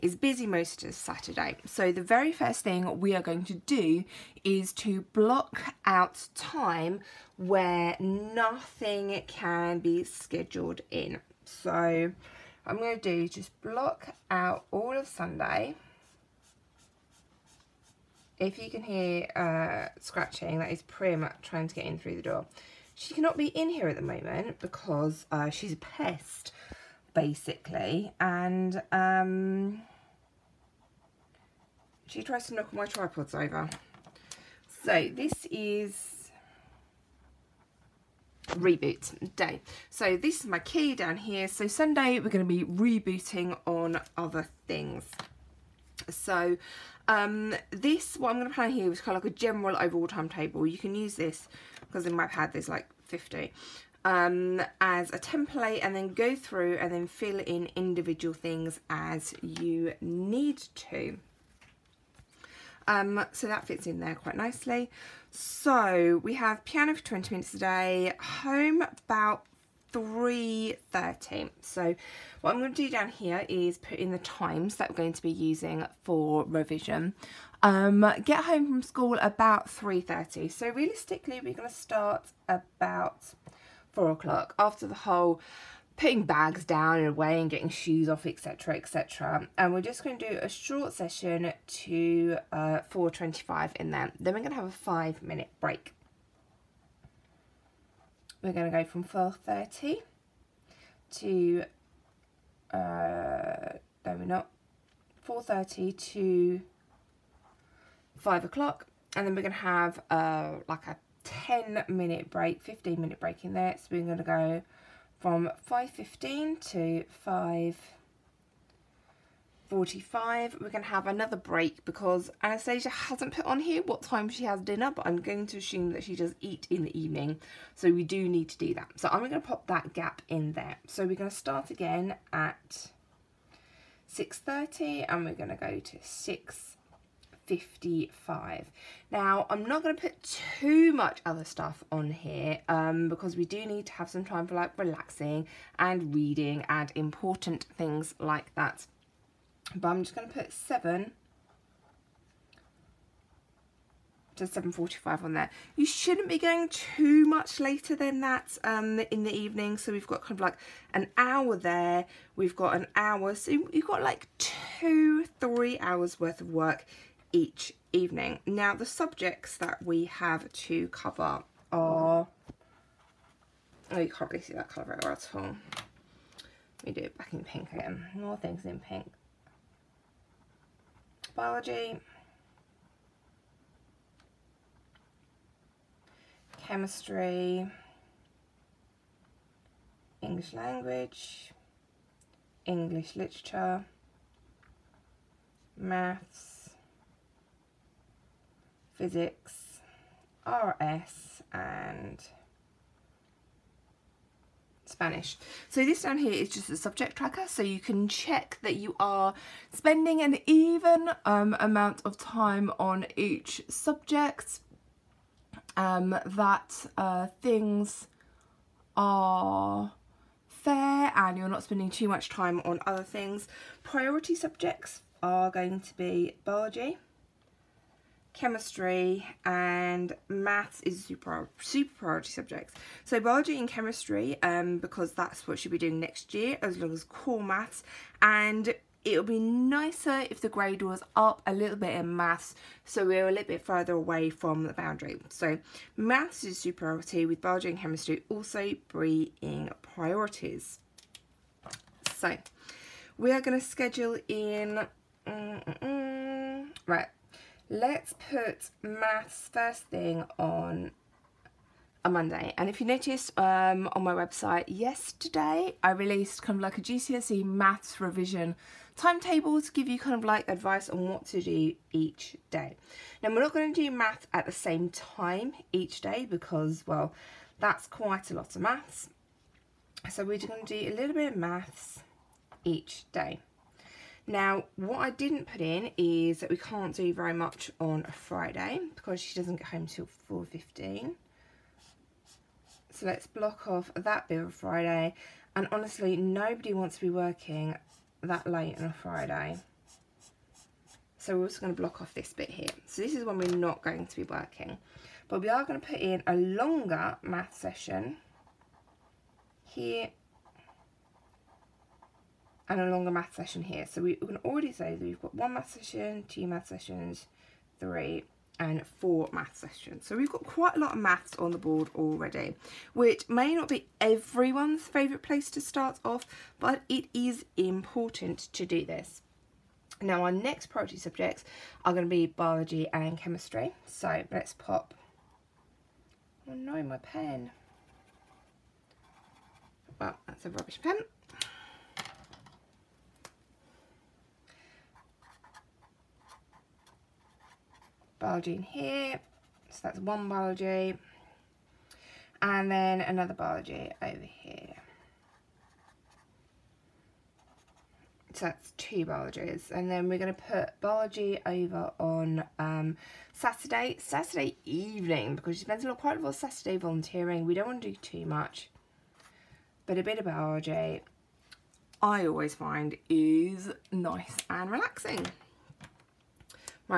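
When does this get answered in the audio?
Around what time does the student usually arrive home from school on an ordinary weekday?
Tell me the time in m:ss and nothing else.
1:08.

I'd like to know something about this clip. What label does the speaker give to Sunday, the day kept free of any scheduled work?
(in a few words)
reboot day.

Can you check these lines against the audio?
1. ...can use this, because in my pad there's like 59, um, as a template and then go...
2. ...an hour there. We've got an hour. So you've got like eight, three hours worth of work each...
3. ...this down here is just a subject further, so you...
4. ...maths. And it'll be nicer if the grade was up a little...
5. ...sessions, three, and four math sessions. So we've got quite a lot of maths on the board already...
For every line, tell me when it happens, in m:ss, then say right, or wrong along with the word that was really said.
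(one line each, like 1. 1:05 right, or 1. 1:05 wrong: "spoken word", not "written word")
1. 0:50 wrong: "50", not "59"
2. 2:40 wrong: "two", not "eight"
3. 3:25 wrong: "tracker", not "further"
4. 3:57 right
5. 5:16 right.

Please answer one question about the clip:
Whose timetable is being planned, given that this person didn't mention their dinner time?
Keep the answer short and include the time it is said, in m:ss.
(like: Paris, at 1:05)
Anastasia, at 2:02.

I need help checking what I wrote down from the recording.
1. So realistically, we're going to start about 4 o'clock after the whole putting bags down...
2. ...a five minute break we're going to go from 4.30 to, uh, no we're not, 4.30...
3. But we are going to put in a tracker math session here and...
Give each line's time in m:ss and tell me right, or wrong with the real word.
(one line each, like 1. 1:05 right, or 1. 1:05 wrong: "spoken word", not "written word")
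1. 1:20 right
2. 1:34 right
3. 5:05 wrong: "longer", not "tracker".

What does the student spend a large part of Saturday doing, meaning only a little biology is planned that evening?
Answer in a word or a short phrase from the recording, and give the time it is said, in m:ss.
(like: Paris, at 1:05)
volunteering, at 6:06.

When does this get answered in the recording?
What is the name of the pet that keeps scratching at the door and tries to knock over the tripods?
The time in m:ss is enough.
0:20.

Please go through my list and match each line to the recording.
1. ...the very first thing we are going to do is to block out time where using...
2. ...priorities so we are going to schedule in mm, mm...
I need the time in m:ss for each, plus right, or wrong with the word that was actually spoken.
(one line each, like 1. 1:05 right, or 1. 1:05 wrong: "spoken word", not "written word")
1. 0:01 wrong: "nothing", not "using"
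2. 4:09 right.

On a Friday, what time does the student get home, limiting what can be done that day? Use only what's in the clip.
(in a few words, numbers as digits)
4.15.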